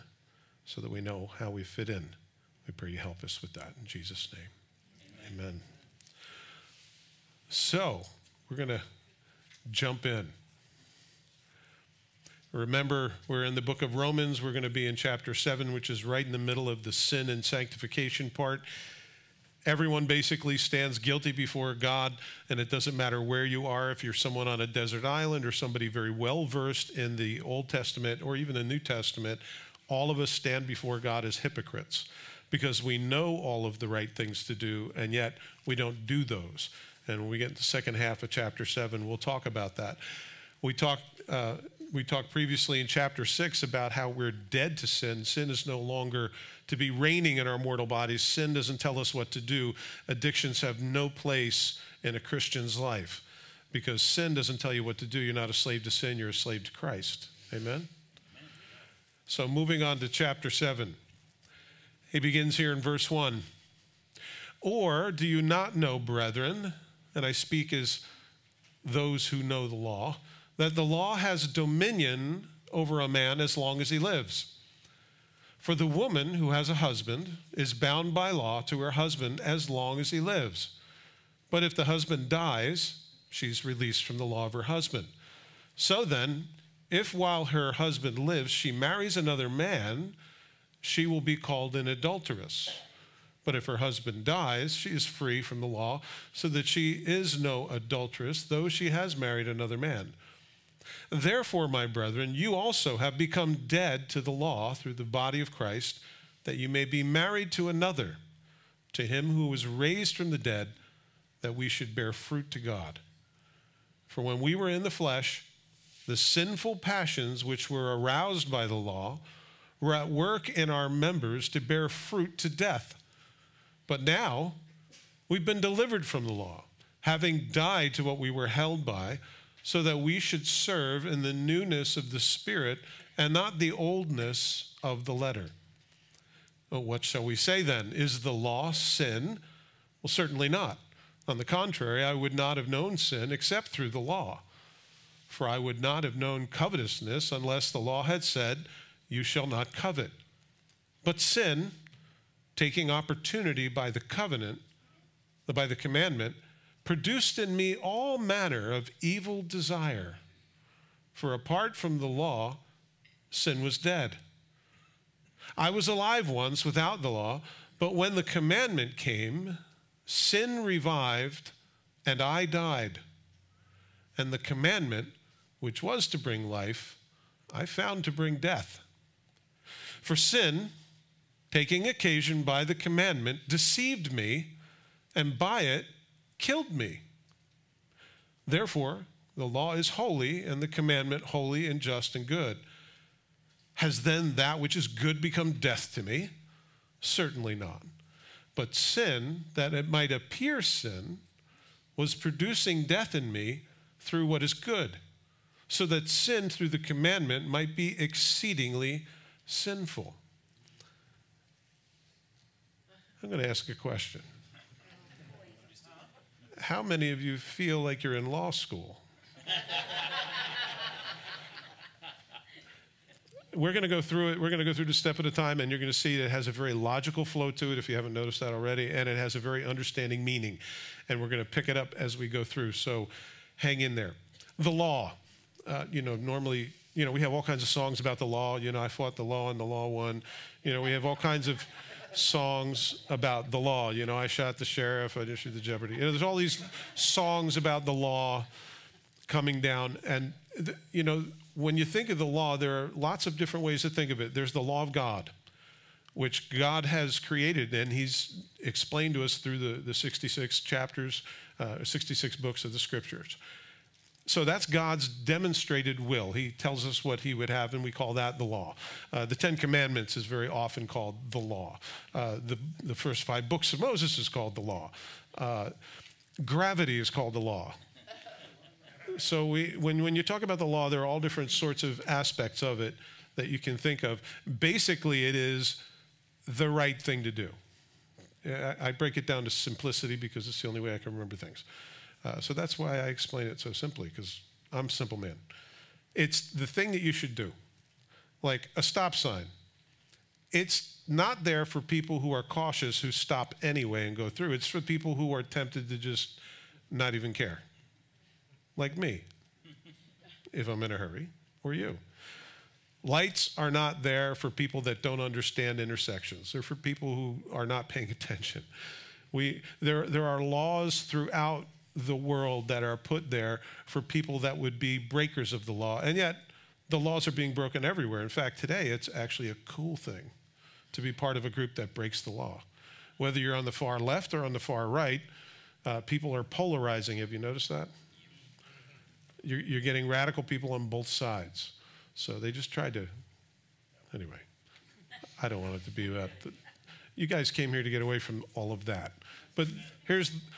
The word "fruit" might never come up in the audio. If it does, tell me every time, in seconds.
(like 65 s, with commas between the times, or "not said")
112 s, 121 s.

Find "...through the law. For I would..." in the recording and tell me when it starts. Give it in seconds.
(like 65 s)
143 s.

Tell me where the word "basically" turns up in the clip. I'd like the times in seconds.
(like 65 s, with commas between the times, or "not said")
20 s, 284 s.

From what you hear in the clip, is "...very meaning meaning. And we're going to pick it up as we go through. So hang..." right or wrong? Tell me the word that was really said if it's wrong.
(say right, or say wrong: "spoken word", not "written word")
wrong: "understanding", not "meaning".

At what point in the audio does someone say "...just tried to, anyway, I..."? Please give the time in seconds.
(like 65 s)
342 s.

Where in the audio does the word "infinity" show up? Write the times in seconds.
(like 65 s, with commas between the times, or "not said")
not said.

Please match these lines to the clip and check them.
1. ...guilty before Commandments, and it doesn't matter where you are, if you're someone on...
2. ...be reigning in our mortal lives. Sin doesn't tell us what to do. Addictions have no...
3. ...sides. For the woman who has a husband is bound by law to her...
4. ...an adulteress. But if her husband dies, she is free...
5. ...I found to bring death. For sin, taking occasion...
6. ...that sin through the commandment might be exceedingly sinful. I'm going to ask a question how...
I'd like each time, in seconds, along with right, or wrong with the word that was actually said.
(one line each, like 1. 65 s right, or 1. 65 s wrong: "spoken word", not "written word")
1. 20 s wrong: "God", not "Commandments"
2. 46 s wrong: "bodies", not "lives"
3. 73 s wrong: "lives", not "sides"
4. 91 s right
5. 177 s right
6. 205 s right.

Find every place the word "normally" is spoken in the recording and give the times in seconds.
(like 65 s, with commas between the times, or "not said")
236 s.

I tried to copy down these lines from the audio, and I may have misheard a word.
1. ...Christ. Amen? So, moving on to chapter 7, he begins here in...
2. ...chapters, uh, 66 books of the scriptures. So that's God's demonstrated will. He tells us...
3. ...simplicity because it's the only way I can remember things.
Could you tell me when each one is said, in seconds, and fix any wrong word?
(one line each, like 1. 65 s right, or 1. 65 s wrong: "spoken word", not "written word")
1. 56 s right
2. 260 s right
3. 289 s right.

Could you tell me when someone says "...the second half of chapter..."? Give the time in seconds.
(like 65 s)
37 s.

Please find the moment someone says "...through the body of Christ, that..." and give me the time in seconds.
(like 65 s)
104 s.